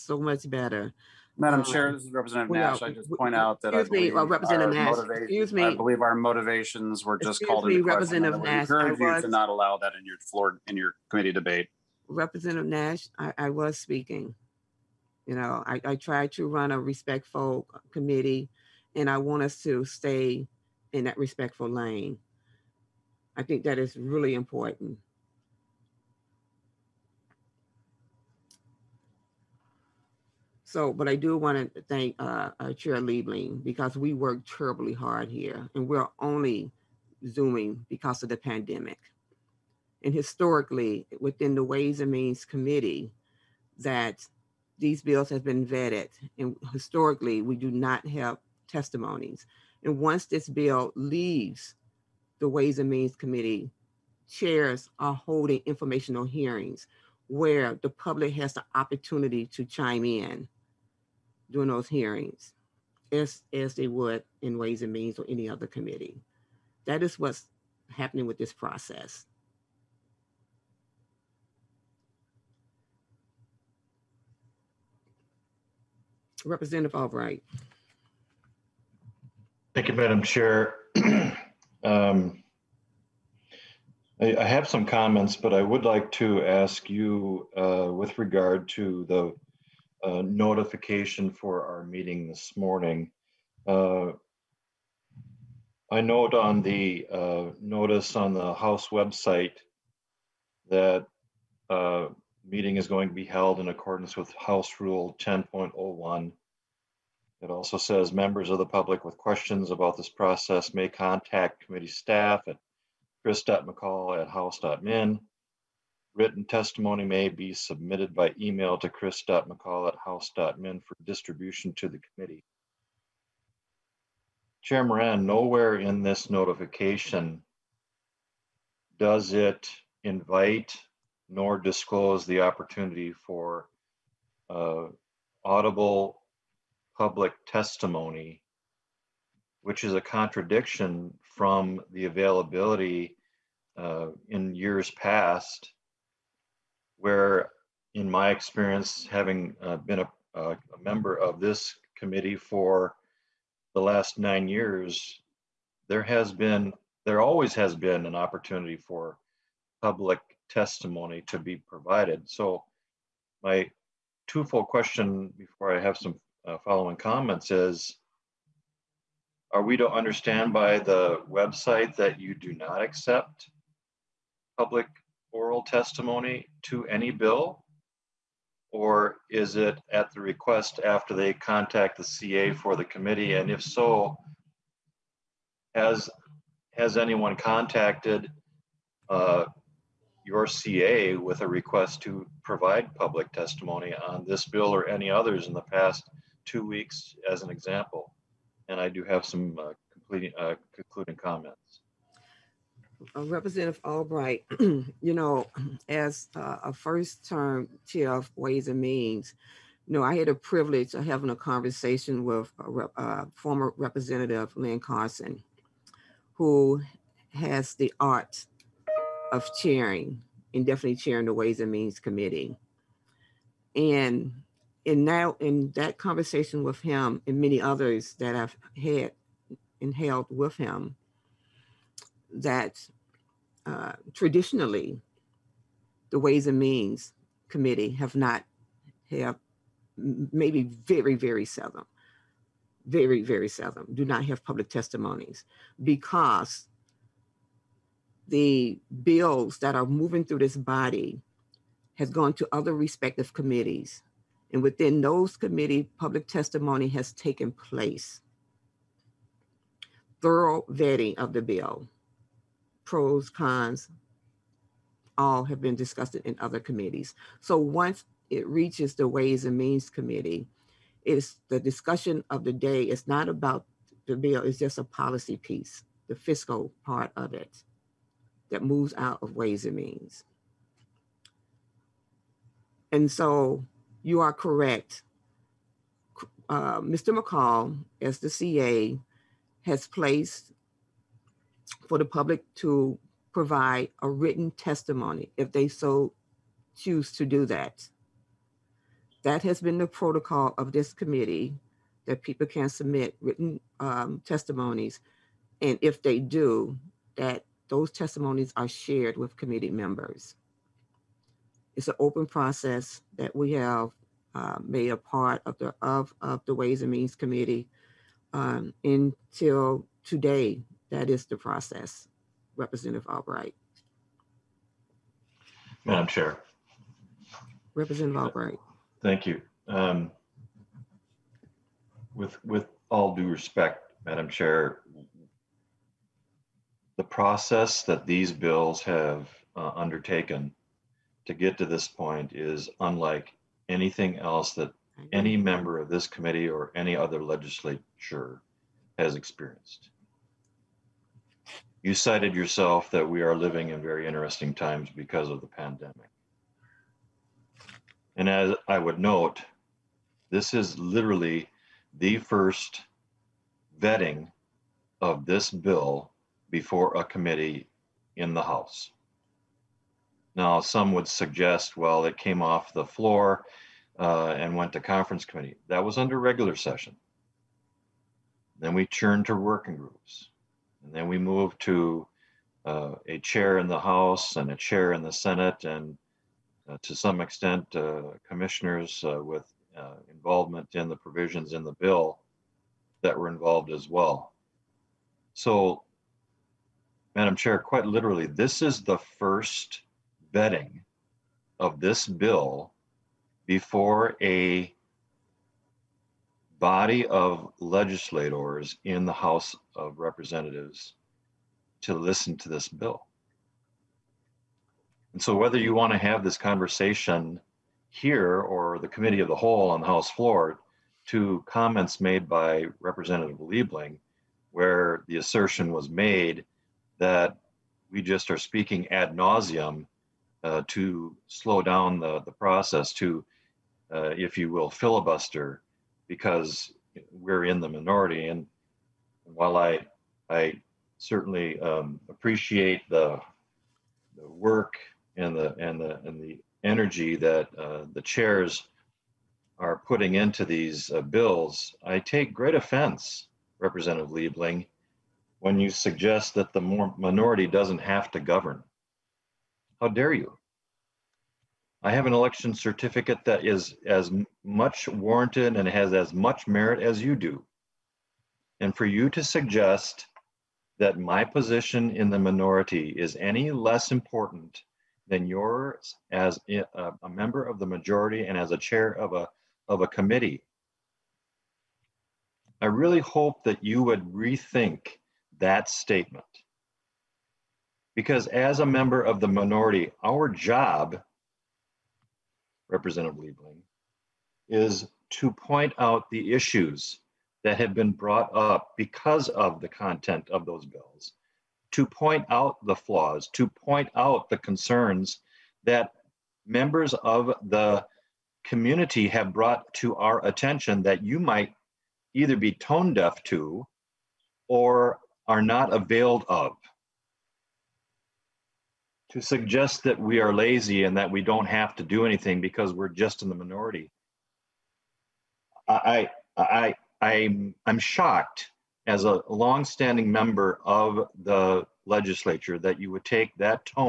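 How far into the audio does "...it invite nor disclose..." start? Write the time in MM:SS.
02:09.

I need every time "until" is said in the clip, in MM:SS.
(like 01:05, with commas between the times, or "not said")
05:18.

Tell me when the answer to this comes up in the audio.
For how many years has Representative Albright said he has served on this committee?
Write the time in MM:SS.
02:34.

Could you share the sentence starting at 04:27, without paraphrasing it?
So once it reaches the Ways and Means Committee, it's the discussion of the day.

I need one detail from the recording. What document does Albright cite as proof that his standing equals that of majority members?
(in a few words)
election certificate.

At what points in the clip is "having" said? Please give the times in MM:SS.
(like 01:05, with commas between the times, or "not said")
02:29, 03:31.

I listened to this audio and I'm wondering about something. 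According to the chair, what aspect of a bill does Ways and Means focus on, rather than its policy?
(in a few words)
the fiscal part.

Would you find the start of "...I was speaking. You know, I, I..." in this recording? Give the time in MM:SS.
00:13.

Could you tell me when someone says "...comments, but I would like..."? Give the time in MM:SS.
01:24.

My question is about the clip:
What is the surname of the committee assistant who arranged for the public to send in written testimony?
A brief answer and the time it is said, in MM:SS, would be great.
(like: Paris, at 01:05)
McCall, at 04:46.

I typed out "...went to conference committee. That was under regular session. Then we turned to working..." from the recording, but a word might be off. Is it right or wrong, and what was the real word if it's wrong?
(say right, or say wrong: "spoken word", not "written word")
right.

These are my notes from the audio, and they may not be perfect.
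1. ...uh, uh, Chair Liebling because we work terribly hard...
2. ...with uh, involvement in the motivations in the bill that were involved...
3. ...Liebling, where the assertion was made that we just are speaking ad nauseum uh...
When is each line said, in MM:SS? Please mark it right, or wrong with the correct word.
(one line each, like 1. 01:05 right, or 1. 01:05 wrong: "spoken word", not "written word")
1. 00:32 right
2. 06:29 wrong: "provisions", not "motivations"
3. 07:03 right.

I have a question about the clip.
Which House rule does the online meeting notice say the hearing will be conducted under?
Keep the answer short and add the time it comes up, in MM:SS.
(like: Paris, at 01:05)
House Rule 10.01, at 01:44.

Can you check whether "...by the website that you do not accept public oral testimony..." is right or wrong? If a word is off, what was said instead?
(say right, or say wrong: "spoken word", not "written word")
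right.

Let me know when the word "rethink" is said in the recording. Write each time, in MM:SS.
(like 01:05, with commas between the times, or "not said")
08:04.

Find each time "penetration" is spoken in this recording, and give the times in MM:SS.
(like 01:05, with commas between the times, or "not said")
not said.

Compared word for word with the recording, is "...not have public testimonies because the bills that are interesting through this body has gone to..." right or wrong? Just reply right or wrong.
wrong.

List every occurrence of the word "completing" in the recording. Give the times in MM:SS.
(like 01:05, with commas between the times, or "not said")
03:19.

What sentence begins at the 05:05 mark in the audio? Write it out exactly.
And if they do, that those testimonies are shared with committee members.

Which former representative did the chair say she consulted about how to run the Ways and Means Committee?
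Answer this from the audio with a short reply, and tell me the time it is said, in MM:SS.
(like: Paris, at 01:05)
Lynn Carson, at 03:34.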